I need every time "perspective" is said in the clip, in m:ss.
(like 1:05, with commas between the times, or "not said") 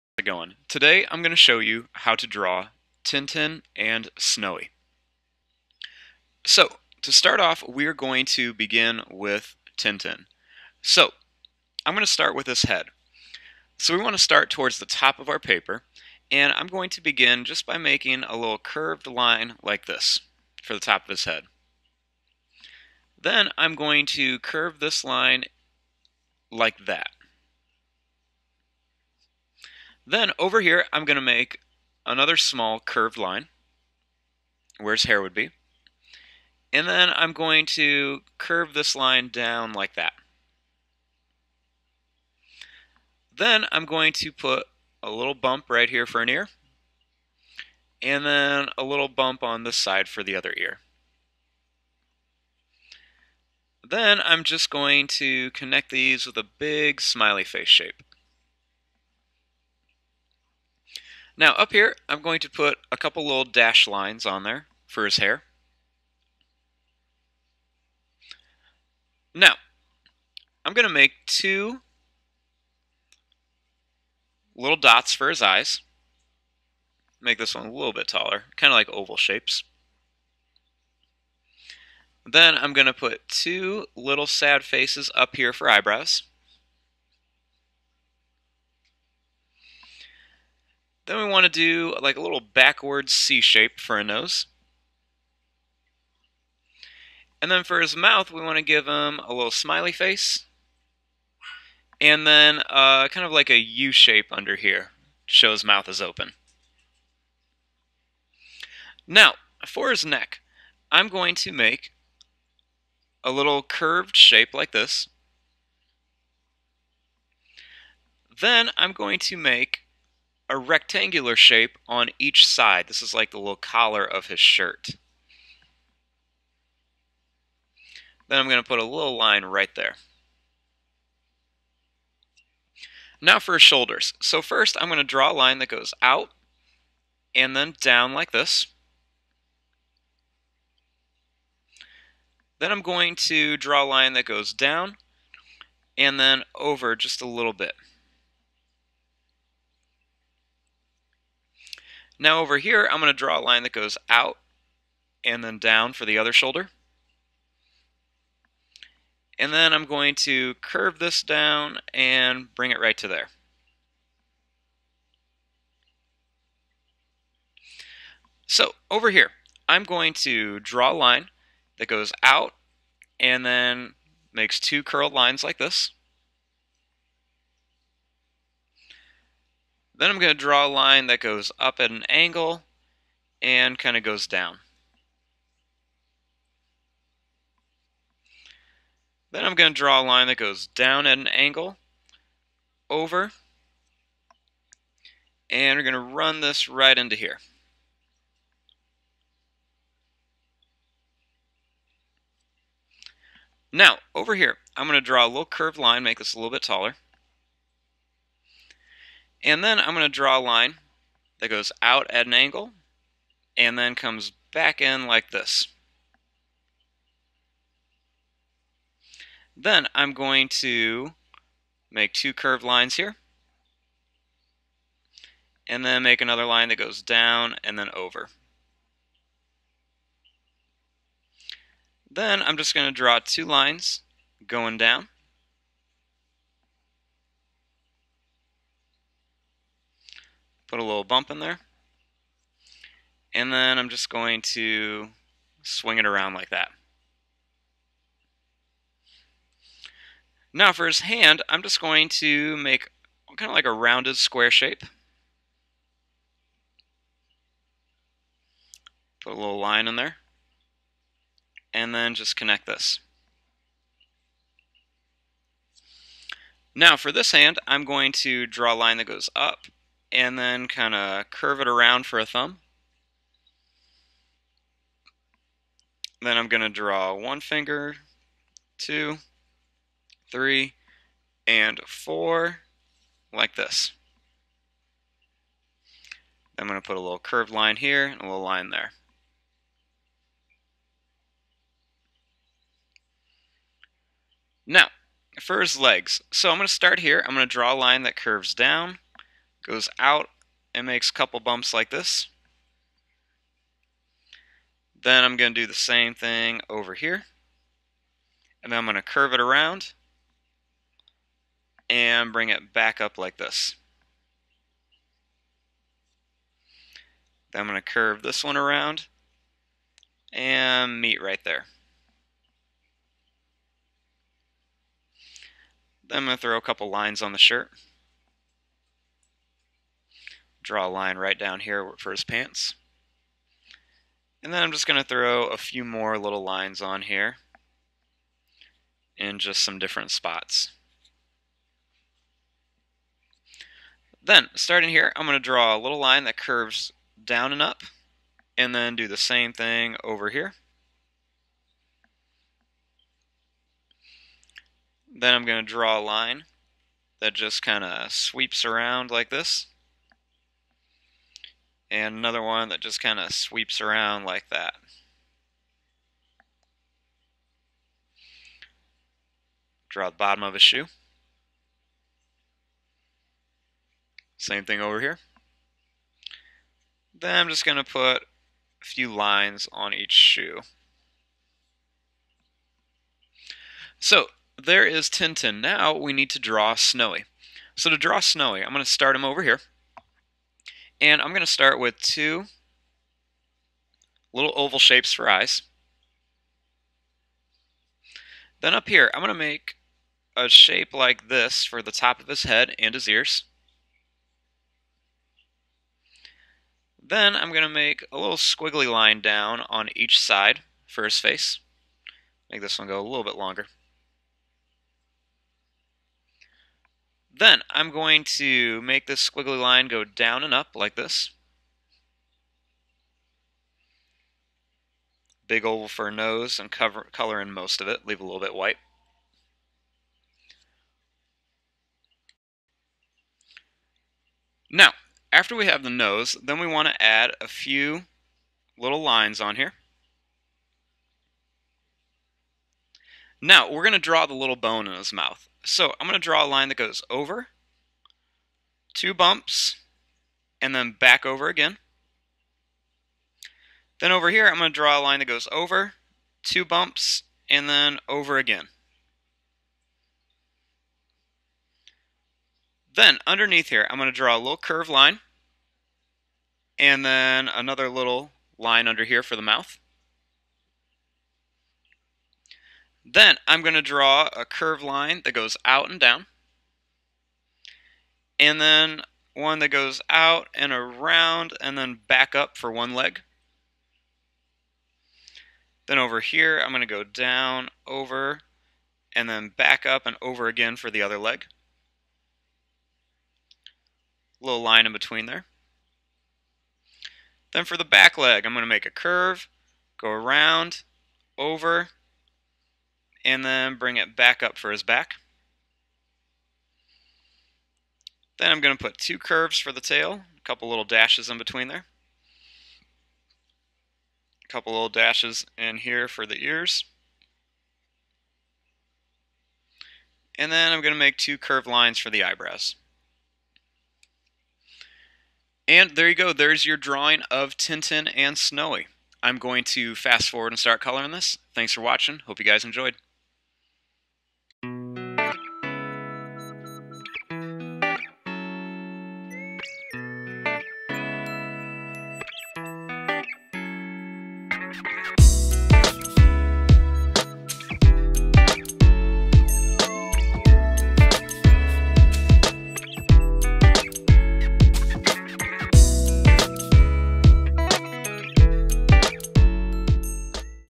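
not said.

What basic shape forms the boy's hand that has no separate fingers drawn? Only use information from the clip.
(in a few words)
Rounded square.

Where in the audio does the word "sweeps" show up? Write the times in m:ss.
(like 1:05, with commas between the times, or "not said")
5:58, 6:03.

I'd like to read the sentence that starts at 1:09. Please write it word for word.
Now, I'm going to make two little dots for his eyes.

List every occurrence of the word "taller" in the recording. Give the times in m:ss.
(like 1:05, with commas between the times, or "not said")
1:18, 3:26.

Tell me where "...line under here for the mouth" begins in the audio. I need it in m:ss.
7:48.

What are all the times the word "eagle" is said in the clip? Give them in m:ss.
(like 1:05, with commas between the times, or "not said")
not said.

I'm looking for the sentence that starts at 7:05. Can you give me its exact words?
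Big oval for a nose and cover, color in most of it, leave a little bit white.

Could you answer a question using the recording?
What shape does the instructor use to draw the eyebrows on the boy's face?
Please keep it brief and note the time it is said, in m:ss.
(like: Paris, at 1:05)
Sad faces, at 1:24.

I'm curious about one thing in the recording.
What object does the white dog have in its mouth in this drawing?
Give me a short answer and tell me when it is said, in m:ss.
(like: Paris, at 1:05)
Bone, at 7:24.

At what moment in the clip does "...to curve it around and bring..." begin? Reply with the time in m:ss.
5:08.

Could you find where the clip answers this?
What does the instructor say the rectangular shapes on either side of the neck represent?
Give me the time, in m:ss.
2:03.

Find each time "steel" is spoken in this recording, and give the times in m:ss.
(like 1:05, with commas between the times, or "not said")
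not said.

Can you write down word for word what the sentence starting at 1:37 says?
And then for his mouth, we want to give him a little smiley face.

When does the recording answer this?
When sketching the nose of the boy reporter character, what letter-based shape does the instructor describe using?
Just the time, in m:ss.
1:32.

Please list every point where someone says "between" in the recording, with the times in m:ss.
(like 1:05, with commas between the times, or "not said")
8:14, 8:31.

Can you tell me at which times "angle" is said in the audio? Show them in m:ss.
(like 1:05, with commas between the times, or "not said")
3:02, 3:11, 3:32.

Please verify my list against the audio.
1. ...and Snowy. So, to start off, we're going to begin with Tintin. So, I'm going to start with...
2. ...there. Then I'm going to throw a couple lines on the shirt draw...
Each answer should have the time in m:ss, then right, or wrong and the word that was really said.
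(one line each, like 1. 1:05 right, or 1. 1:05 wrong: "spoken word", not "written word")
1. 0:03 right
2. 5:21 right.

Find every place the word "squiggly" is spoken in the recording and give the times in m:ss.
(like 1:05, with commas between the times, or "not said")
6:48, 6:59.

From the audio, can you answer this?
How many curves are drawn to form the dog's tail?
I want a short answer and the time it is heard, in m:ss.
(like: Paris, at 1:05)
2, at 8:28.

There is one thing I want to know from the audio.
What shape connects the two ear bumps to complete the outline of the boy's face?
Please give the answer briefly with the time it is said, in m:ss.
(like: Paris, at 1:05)
Big smiley face shape, at 0:56.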